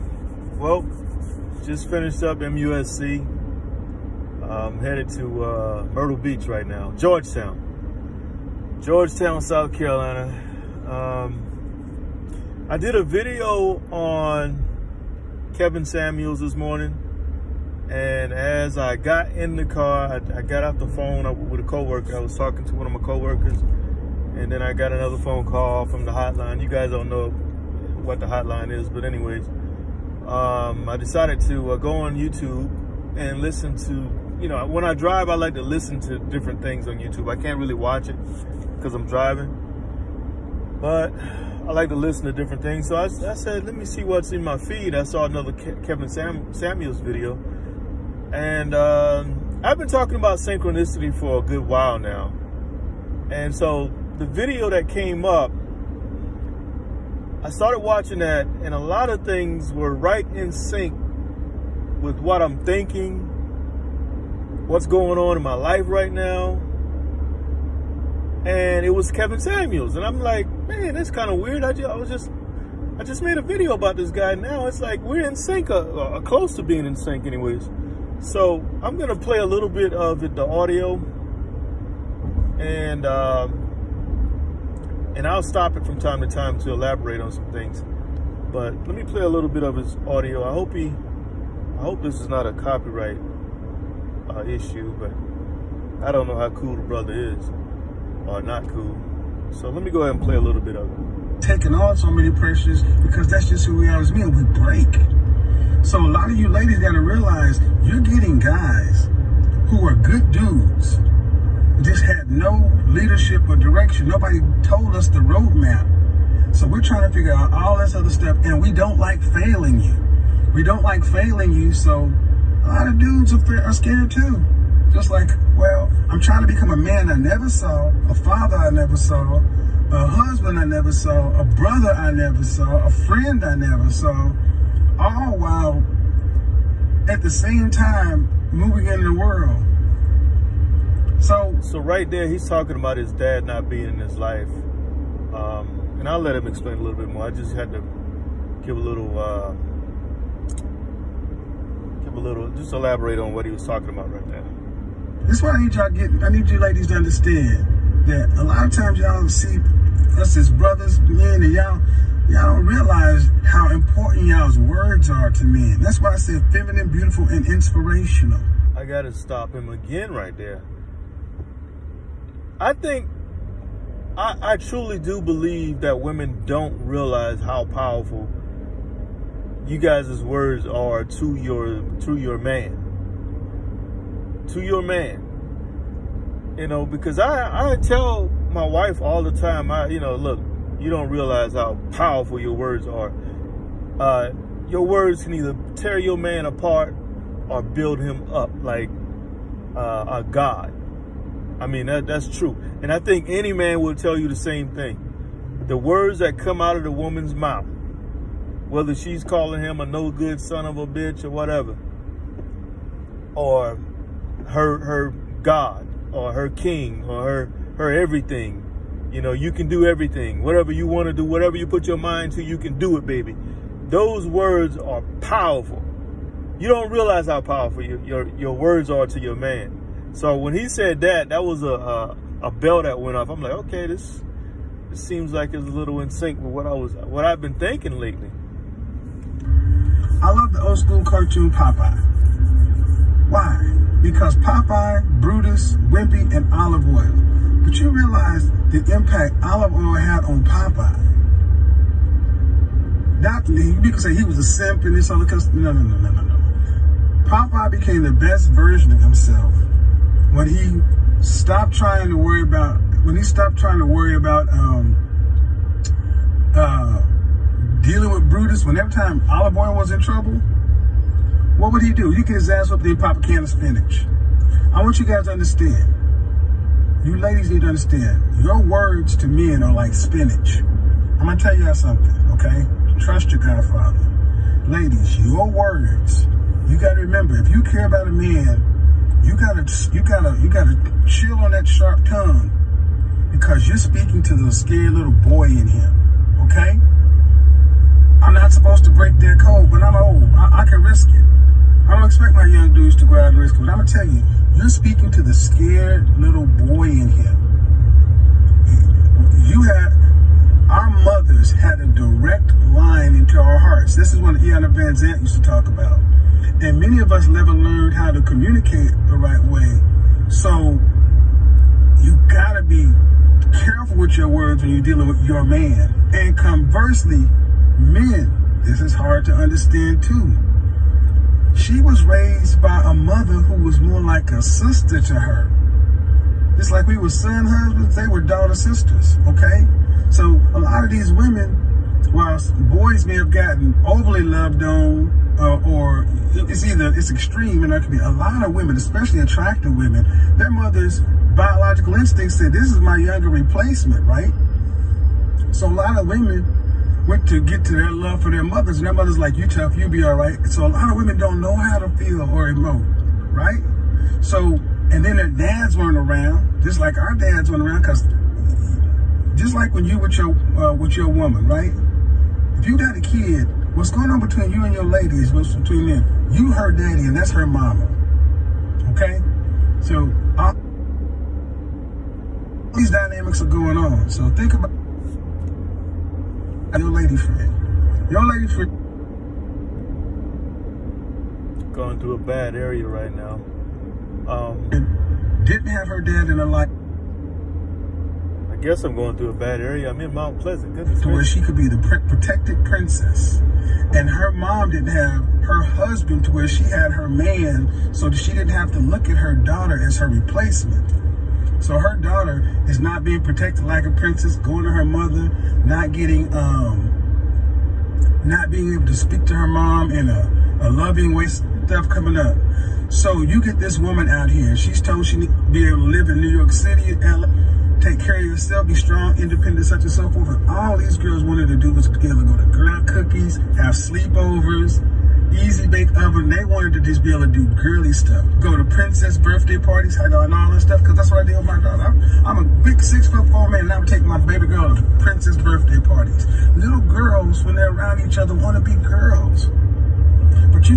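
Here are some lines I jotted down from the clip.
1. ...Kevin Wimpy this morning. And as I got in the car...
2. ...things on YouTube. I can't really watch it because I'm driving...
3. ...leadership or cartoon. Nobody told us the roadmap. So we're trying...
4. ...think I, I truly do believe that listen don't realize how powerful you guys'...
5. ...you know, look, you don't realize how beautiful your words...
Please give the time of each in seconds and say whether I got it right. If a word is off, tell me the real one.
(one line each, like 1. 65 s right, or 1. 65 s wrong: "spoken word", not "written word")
1. 15 s wrong: "Samuels", not "Wimpy"
2. 36 s right
3. 112 s wrong: "direction", not "cartoon"
4. 172 s wrong: "women", not "listen"
5. 189 s wrong: "powerful", not "beautiful".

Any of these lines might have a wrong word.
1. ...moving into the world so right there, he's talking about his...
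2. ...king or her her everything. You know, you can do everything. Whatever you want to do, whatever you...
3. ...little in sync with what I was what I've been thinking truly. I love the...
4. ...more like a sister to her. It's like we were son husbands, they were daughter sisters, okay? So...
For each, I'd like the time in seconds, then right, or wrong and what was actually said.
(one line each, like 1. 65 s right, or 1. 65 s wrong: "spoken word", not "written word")
1. 138 s right
2. 216 s right
3. 235 s wrong: "lately", not "truly"
4. 333 s right.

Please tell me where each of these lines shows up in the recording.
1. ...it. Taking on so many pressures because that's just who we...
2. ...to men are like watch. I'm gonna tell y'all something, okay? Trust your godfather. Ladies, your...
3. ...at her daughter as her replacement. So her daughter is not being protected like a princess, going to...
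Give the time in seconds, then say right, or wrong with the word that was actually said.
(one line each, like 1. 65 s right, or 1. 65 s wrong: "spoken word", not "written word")
1. 100 s right
2. 279 s wrong: "spinach", not "watch"
3. 409 s right.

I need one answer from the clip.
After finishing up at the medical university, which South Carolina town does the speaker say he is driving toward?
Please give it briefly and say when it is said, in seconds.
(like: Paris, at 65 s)
Georgetown, at 8 s.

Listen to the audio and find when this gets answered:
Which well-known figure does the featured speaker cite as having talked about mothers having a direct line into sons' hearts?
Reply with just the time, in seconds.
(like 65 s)
314 s.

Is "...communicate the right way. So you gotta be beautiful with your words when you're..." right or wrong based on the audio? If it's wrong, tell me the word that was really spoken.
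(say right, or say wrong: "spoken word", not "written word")
wrong: "careful", not "beautiful".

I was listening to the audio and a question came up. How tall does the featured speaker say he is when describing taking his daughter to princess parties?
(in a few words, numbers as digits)
6 foot 4.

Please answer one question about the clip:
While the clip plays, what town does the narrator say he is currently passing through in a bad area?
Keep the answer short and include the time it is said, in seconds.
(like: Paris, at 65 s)
Mount Pleasant, at 400 s.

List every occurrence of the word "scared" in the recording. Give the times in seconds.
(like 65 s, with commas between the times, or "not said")
123 s, 294 s, 305 s.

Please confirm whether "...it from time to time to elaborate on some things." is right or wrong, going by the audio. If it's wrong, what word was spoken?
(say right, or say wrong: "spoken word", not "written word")
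right.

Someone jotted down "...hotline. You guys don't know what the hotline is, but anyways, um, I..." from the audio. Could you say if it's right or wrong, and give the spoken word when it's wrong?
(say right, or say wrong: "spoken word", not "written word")
right.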